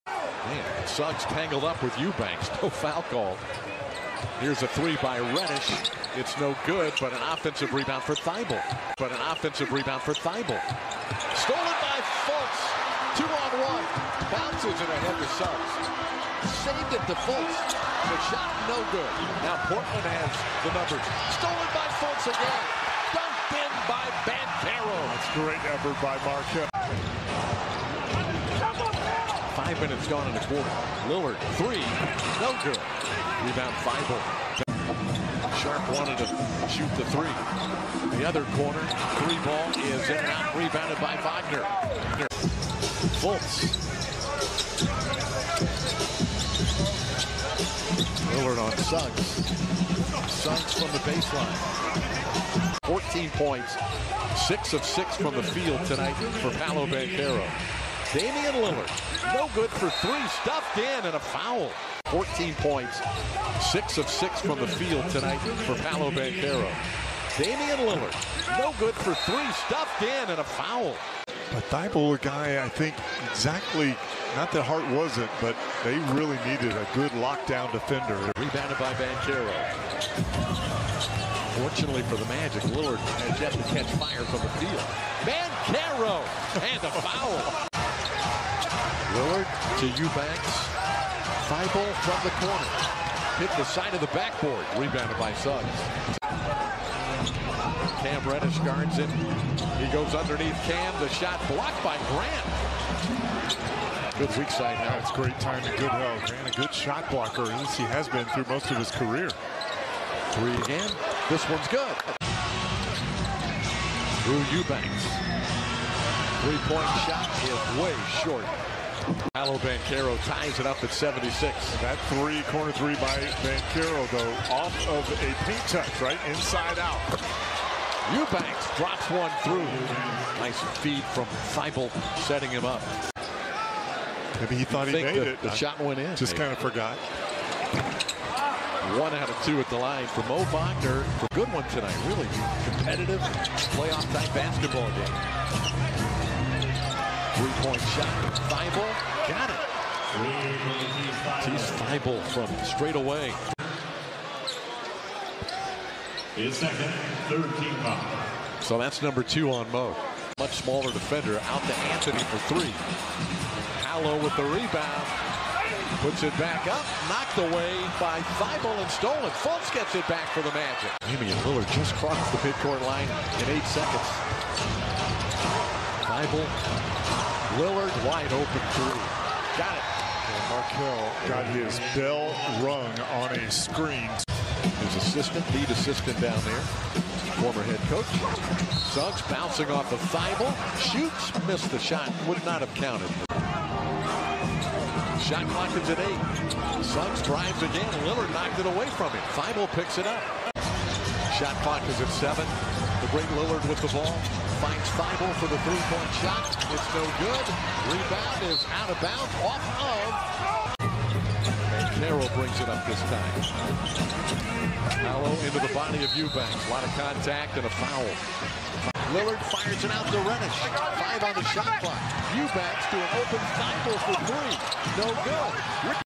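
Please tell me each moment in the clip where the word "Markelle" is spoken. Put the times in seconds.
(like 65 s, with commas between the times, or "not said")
26 s, 180 s.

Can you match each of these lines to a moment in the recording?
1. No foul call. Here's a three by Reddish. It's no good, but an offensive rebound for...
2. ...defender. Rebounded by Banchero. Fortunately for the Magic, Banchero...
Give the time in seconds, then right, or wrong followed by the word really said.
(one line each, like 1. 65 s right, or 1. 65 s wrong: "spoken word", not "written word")
1. 2 s right
2. 77 s wrong: "Lillard", not "Banchero".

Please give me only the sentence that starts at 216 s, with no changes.
A lot of contact and a foul.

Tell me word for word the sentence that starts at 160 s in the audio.
Much smaller defender out to Anthony for three.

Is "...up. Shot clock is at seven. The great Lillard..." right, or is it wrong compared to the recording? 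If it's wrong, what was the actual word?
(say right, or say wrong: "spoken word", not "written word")
right.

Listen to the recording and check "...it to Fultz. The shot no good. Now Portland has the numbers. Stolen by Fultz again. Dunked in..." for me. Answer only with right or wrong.
right.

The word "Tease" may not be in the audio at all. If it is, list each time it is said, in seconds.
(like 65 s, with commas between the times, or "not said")
151 s.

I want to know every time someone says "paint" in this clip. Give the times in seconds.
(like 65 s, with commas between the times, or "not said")
125 s.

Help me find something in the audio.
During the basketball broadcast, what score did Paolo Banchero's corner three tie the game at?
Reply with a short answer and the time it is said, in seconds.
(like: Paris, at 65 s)
76, at 120 s.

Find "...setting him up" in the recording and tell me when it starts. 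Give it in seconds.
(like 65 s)
132 s.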